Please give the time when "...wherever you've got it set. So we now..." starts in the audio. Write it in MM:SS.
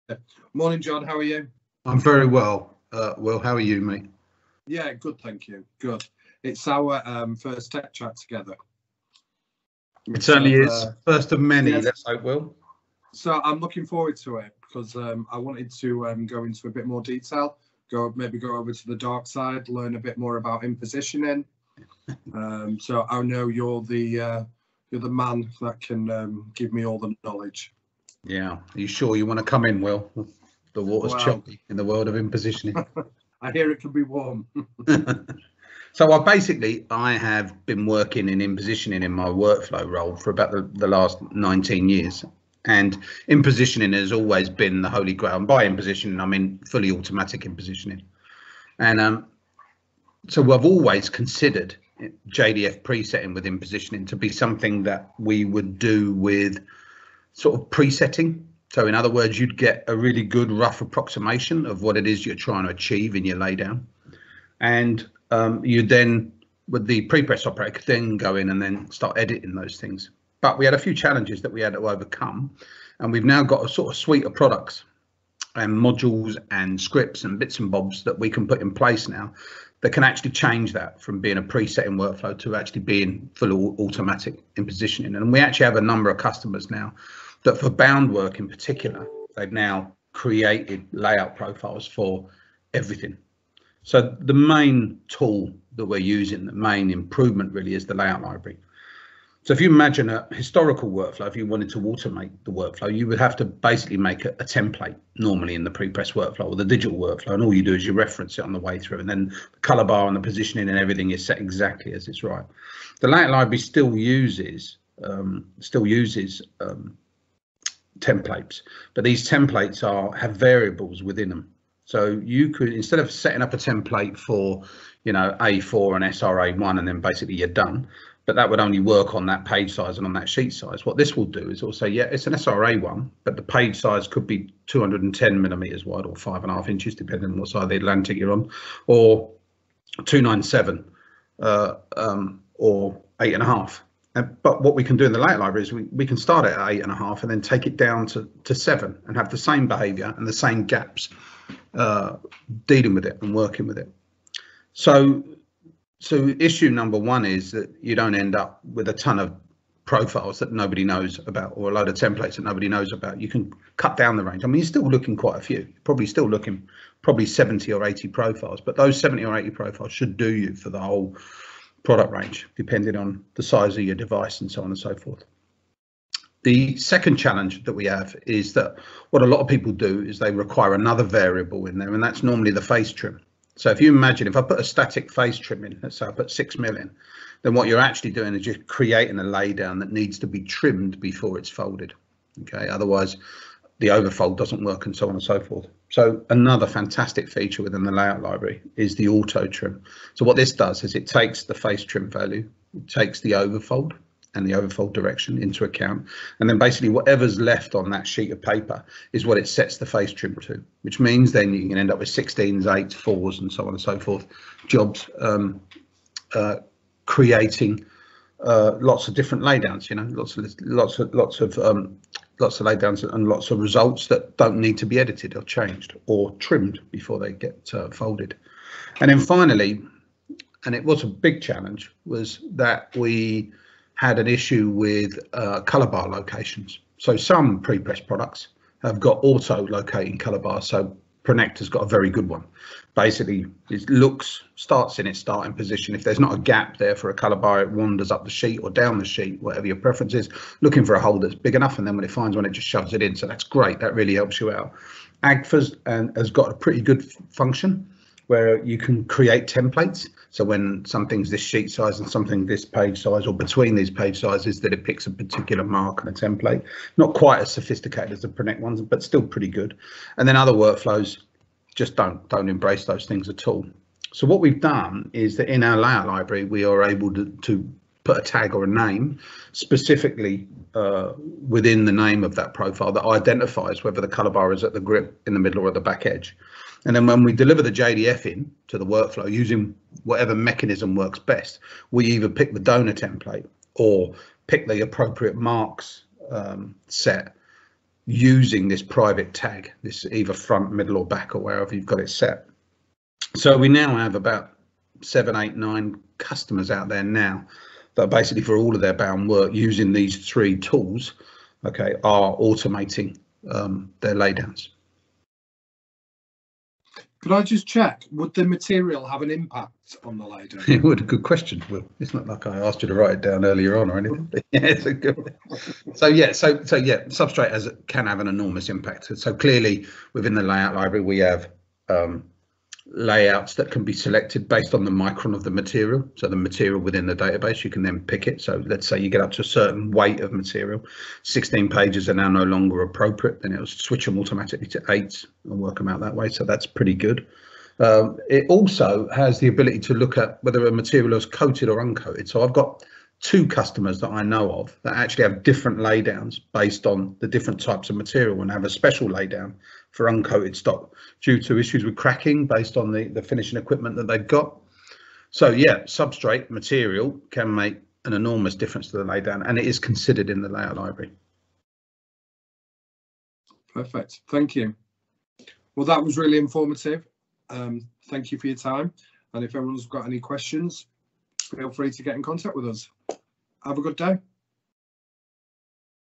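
05:01.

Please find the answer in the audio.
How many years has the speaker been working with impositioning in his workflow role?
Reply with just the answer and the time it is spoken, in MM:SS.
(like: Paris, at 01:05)
19 years, at 00:41.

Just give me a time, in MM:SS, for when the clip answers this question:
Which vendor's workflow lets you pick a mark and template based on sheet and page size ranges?
04:15.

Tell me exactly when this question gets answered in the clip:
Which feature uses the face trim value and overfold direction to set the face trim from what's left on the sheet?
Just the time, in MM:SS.
03:19.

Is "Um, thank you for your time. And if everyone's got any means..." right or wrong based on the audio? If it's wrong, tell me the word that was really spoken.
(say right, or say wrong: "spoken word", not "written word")
wrong: "questions", not "means".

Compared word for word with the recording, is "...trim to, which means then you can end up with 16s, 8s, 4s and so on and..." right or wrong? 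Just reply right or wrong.
right.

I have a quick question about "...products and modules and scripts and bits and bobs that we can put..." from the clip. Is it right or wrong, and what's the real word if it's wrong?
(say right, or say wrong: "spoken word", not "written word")
right.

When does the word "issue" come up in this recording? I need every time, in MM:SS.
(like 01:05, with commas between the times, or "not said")
02:36, 03:54, 06:01.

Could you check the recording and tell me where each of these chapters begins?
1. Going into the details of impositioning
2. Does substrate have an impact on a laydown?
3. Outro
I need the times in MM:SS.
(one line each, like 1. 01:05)
1. 00:36
2. 05:15
3. 06:12.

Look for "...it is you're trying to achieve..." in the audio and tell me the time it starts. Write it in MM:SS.
01:01.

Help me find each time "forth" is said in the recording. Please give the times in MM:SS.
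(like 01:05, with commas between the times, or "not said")
02:54, 03:15, 03:33.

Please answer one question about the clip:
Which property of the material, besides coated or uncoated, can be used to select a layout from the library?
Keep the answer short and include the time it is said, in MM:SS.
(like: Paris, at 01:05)
micron, at 05:34.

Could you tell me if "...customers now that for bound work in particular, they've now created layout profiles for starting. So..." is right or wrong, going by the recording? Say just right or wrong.
wrong.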